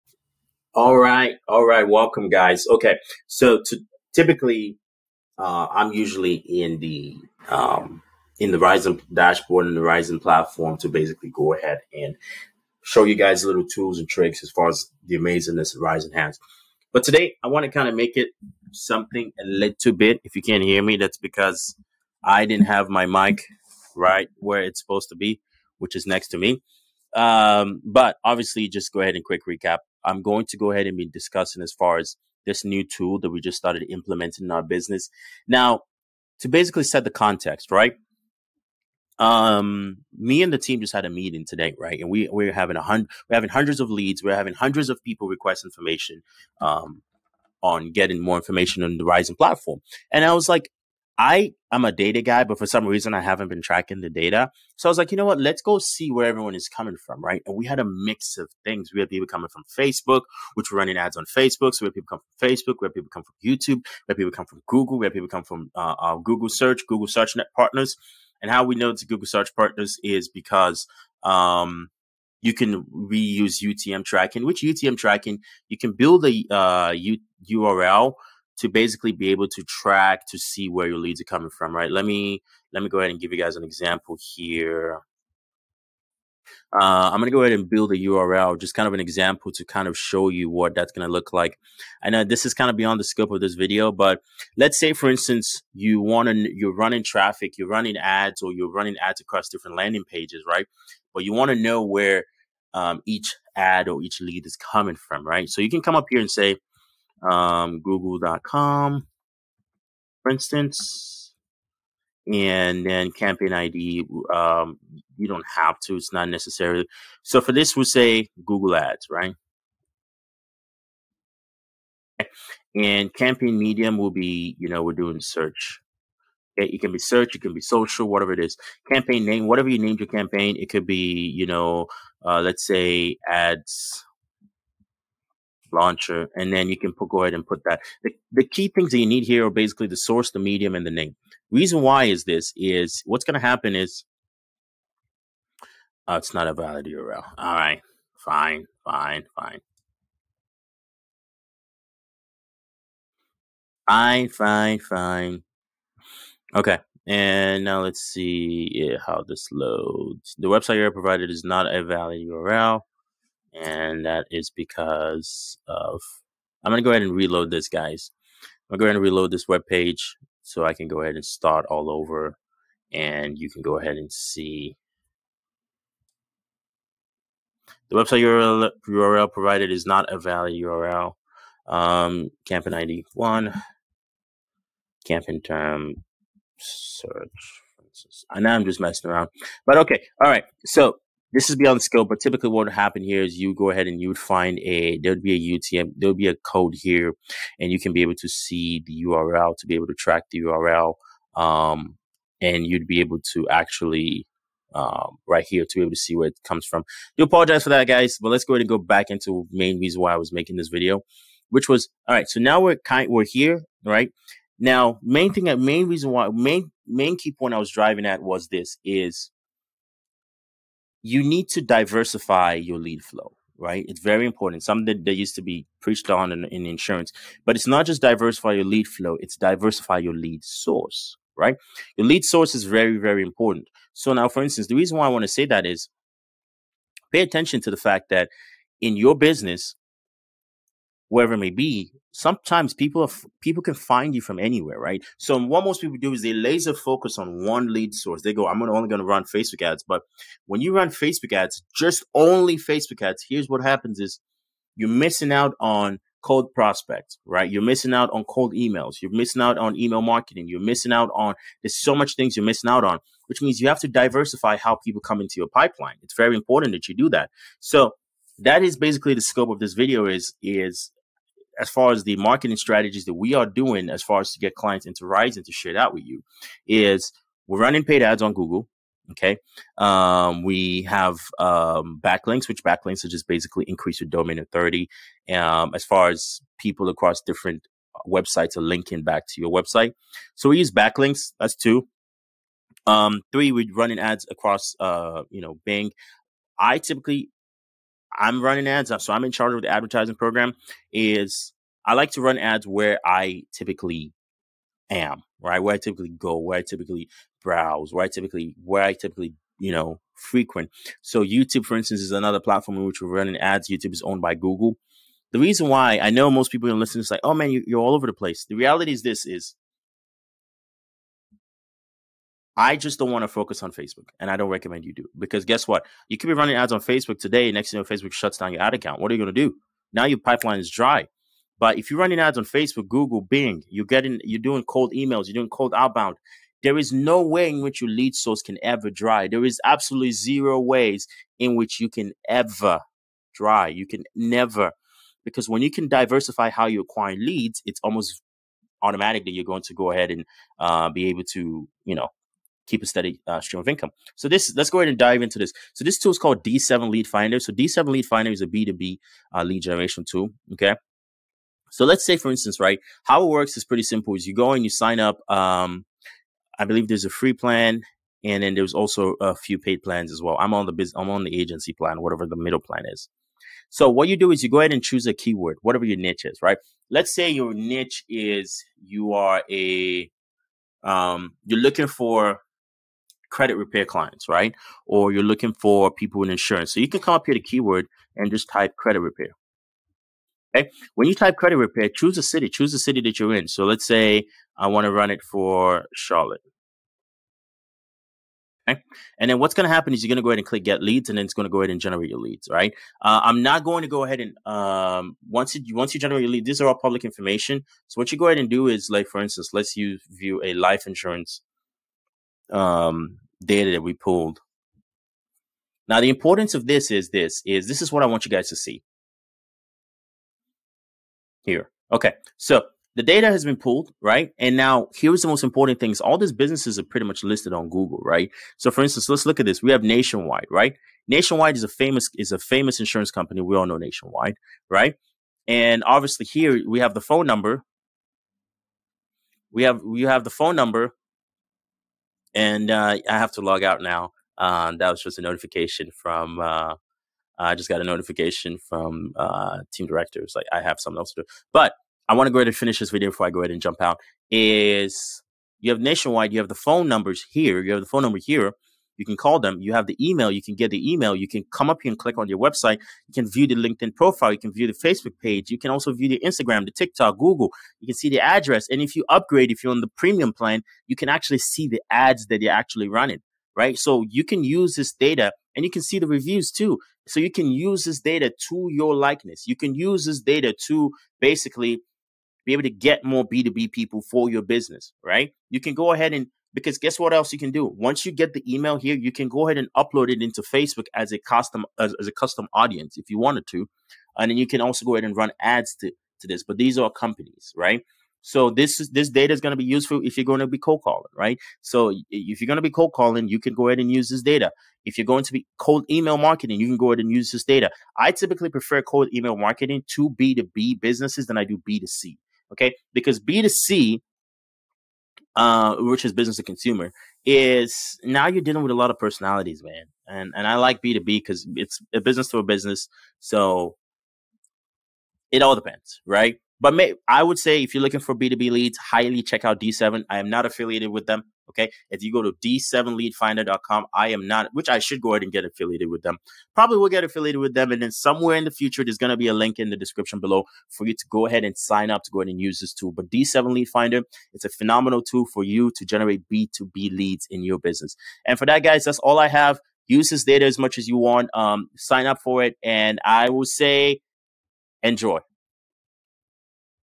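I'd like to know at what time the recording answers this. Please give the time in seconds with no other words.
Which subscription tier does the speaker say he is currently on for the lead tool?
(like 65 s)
371 s.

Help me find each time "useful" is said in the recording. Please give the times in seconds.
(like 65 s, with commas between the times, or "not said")
499 s.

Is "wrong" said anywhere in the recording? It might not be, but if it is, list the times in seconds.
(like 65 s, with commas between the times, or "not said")
not said.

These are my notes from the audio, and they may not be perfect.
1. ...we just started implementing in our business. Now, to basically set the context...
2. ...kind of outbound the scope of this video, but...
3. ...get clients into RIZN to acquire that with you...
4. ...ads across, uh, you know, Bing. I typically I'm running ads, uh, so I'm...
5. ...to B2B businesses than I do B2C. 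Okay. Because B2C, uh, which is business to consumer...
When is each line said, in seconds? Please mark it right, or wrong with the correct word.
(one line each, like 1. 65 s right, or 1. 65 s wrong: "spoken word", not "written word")
1. 33 s right
2. 92 s wrong: "beyond", not "outbound"
3. 274 s wrong: "share", not "acquire"
4. 293 s right
5. 509 s right.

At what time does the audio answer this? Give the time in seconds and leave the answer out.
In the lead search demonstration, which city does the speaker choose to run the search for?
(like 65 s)
395 s.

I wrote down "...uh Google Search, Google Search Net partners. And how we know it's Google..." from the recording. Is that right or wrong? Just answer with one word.
right.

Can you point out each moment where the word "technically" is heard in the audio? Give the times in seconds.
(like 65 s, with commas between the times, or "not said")
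not said.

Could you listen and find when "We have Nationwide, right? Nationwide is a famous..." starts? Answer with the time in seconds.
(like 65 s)
429 s.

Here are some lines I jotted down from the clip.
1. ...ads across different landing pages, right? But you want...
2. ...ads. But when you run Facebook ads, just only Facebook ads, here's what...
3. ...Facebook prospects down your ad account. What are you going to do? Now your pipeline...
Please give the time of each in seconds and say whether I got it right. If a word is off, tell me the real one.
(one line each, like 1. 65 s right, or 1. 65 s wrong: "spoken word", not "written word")
1. 98 s right
2. 249 s right
3. 327 s wrong: "shuts", not "prospects".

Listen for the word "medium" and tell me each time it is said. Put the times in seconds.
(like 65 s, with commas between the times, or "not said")
123 s, 140 s.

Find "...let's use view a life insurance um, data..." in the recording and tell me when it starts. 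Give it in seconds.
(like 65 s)
409 s.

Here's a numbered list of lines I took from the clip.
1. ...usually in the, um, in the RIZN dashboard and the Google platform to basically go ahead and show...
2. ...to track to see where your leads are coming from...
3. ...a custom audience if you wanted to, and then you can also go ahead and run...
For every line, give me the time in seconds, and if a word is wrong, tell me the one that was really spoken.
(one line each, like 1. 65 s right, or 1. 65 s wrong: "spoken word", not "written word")
1. 5 s wrong: "RIZN", not "Google"
2. 79 s right
3. 492 s right.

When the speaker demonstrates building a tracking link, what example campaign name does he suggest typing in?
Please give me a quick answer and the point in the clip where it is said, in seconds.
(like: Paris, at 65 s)
ads launcher, at 133 s.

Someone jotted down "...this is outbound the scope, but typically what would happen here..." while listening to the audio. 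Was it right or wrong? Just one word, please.
wrong.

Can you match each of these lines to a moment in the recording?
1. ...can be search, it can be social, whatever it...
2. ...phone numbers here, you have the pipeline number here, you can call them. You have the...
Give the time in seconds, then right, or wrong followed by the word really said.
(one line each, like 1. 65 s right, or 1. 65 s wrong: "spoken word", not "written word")
1. 126 s right
2. 456 s wrong: "phone", not "pipeline".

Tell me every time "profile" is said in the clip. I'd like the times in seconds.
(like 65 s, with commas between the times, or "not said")
463 s.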